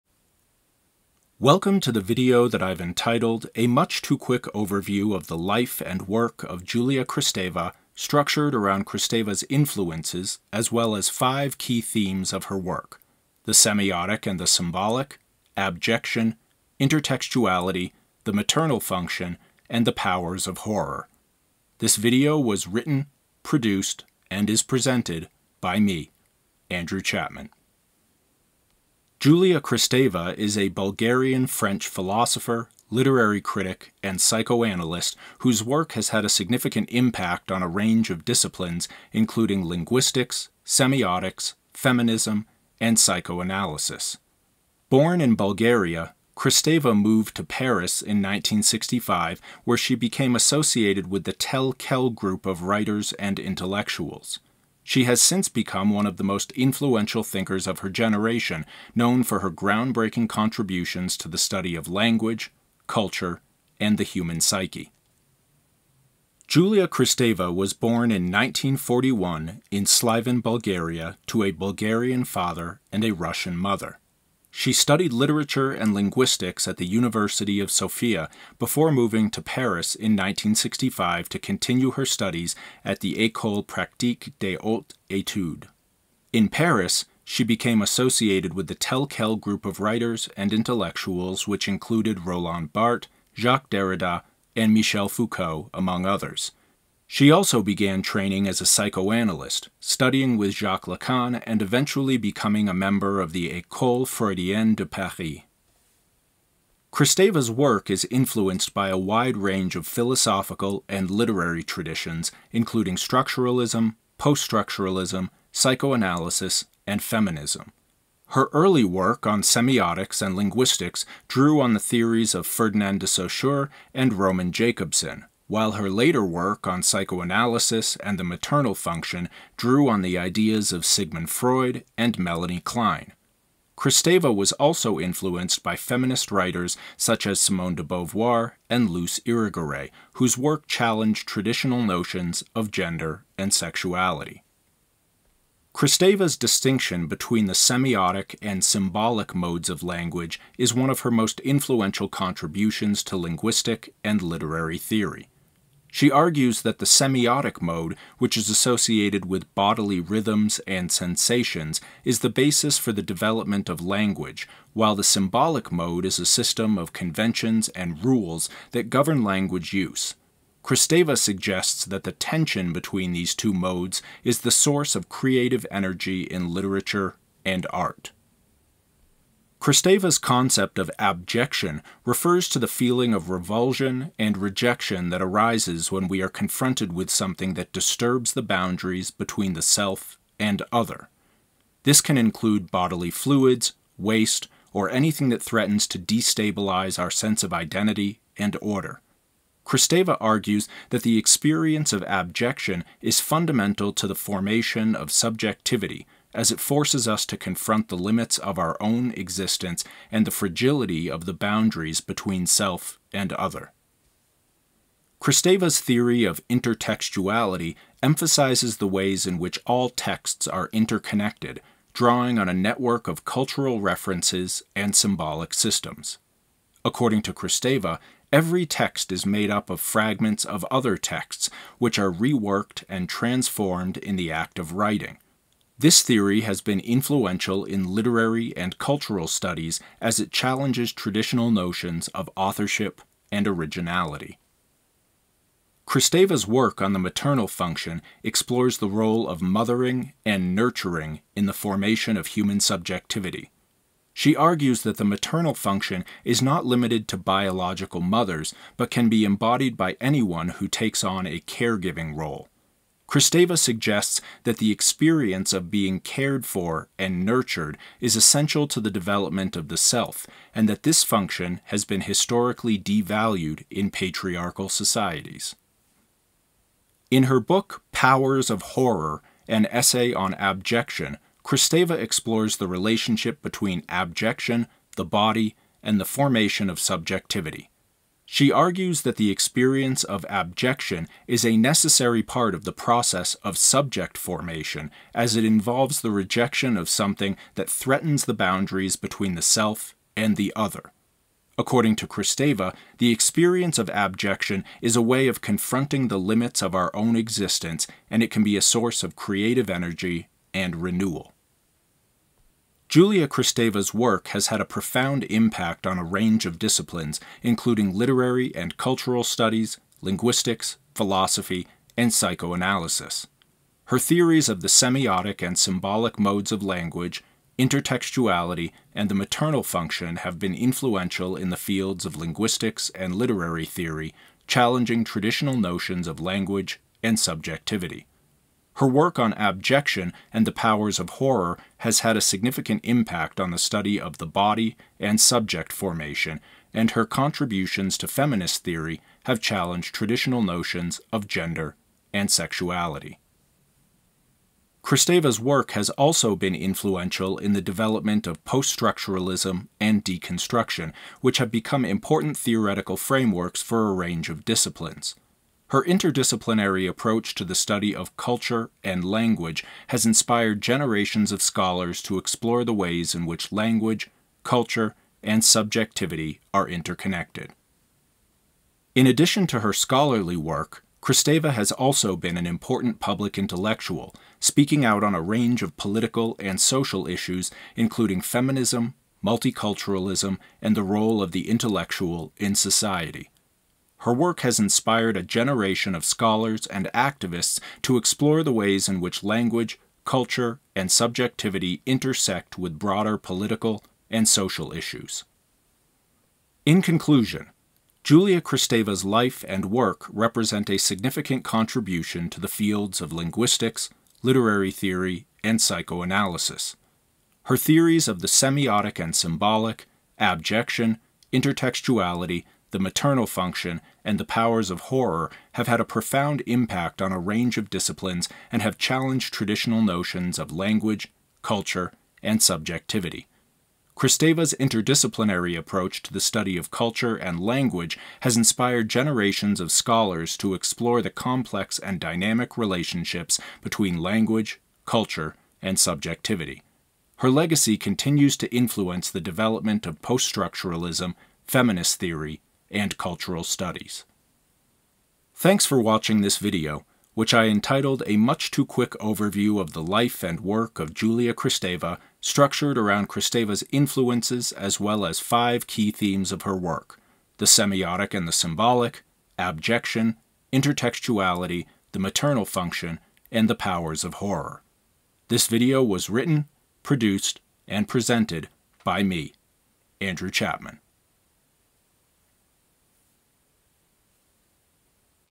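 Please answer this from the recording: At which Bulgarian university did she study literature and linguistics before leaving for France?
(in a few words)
University of Sofia.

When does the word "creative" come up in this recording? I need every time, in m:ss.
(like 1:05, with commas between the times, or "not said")
2:55, 5:09.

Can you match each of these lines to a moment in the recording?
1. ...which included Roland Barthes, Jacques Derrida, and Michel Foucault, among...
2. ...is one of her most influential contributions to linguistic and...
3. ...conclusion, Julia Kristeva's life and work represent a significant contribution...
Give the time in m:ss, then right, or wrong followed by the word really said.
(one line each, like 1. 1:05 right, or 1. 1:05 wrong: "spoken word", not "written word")
1. 1:31 right
2. 2:30 right
3. 6:46 right.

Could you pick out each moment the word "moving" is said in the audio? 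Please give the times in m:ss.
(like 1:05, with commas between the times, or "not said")
1:18.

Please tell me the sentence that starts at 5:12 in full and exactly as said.
Julia Kristeva's work has had a profound impact on a range of disciplines, including literary and cultural studies, linguistics, philosophy, and psychoanalysis.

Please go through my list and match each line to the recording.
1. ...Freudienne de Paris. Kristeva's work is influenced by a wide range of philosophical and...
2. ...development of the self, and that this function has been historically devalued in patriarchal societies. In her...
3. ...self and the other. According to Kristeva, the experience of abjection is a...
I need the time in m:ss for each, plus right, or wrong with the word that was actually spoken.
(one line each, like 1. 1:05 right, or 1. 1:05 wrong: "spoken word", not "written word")
1. 1:44 right
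2. 4:28 right
3. 4:59 right.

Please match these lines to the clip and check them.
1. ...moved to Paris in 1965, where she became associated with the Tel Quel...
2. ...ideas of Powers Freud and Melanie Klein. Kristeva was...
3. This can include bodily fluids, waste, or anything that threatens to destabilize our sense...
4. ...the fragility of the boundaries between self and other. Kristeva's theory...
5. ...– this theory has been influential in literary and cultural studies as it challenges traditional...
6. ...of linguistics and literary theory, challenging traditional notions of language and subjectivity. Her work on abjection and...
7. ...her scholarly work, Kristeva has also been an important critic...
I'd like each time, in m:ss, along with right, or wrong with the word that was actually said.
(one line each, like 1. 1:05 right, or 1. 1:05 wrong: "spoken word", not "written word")
1. 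0:46 right
2. 2:10 wrong: "Sigmund", not "Powers"
3. 3:11 right
4. 3:30 right
5. 3:55 right
6. 5:32 right
7. 6:19 wrong: "public", not "critic".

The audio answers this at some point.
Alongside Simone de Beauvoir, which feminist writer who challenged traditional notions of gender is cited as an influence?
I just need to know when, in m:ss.
2:18.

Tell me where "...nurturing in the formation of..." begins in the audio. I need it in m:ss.
4:10.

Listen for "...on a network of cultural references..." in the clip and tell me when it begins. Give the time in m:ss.
3:42.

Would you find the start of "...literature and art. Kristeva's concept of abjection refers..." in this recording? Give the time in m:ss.
2:56.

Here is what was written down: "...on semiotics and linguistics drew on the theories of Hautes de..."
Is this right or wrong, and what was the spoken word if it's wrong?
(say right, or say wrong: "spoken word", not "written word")
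wrong: "Ferdinand", not "Hautes".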